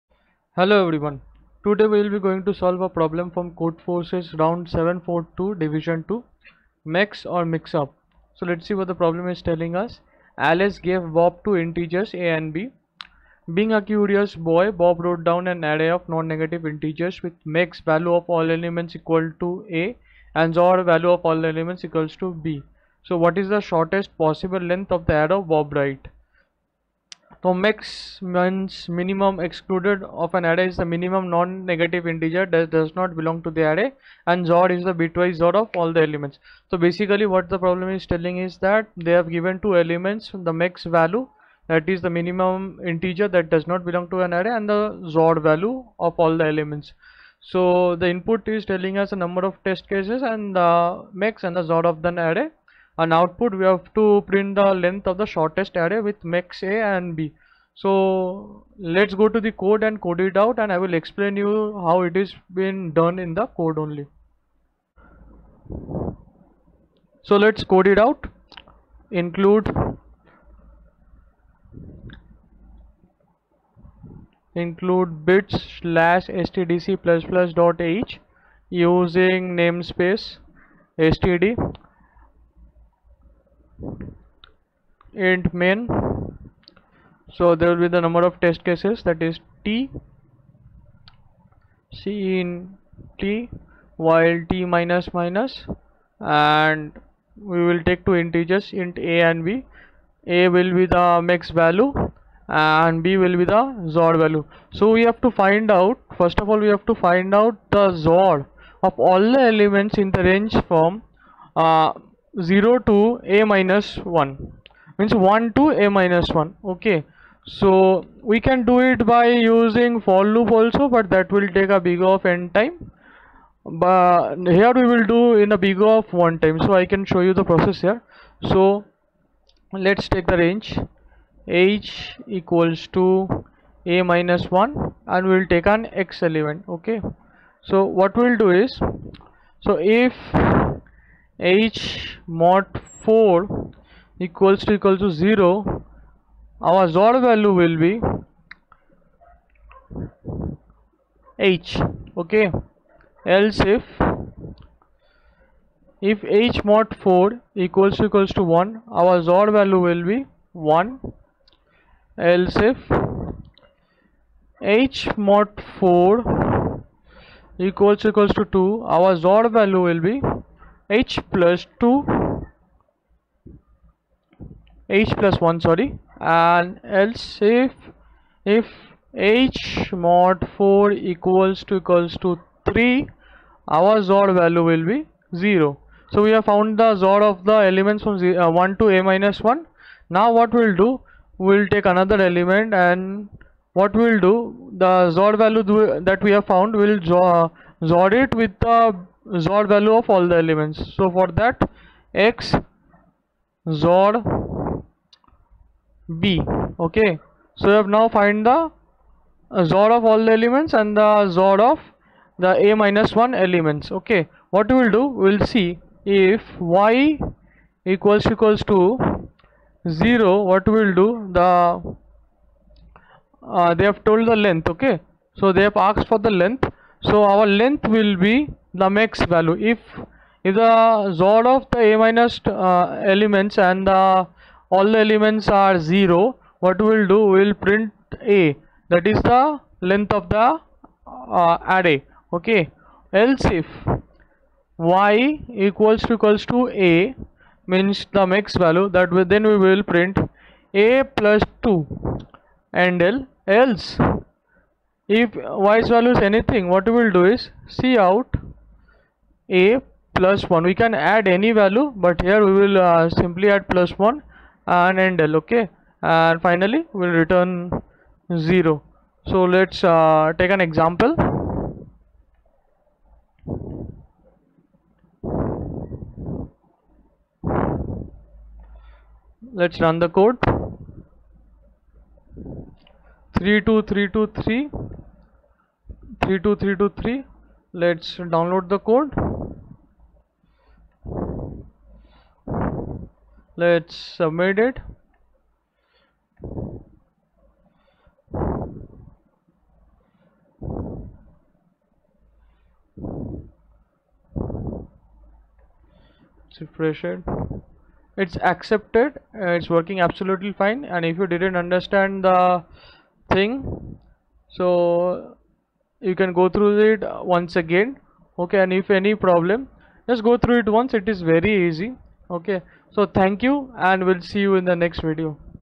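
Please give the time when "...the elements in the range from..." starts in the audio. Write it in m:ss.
1:49.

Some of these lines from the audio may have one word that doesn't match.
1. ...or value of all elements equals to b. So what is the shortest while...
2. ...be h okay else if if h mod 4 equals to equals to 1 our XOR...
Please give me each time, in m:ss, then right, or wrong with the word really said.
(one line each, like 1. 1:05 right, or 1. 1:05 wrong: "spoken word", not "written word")
1. 0:20 wrong: "possible", not "while"
2. 2:27 right.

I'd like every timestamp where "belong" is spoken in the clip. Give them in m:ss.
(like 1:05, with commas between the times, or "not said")
0:33, 0:43.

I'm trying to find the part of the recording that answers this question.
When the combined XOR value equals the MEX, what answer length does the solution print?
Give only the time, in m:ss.
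4:10.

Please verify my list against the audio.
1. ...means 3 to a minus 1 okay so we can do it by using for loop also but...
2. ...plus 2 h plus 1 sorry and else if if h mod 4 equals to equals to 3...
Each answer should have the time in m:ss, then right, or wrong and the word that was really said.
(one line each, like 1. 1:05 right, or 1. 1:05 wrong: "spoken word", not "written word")
1. 1:54 wrong: "1", not "3"
2. 2:51 right.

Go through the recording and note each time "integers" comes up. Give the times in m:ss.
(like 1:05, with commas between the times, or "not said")
0:11, 0:16, 0:32, 0:42, 1:38.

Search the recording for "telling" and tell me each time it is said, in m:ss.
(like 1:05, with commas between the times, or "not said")
0:09, 0:38, 0:48.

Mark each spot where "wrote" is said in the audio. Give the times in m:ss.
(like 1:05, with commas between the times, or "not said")
0:14.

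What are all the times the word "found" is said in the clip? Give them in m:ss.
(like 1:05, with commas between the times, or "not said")
3:06, 3:16.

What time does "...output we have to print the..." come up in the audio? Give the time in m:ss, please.
0:53.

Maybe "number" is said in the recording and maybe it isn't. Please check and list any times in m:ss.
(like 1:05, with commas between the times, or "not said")
0:49, 1:28.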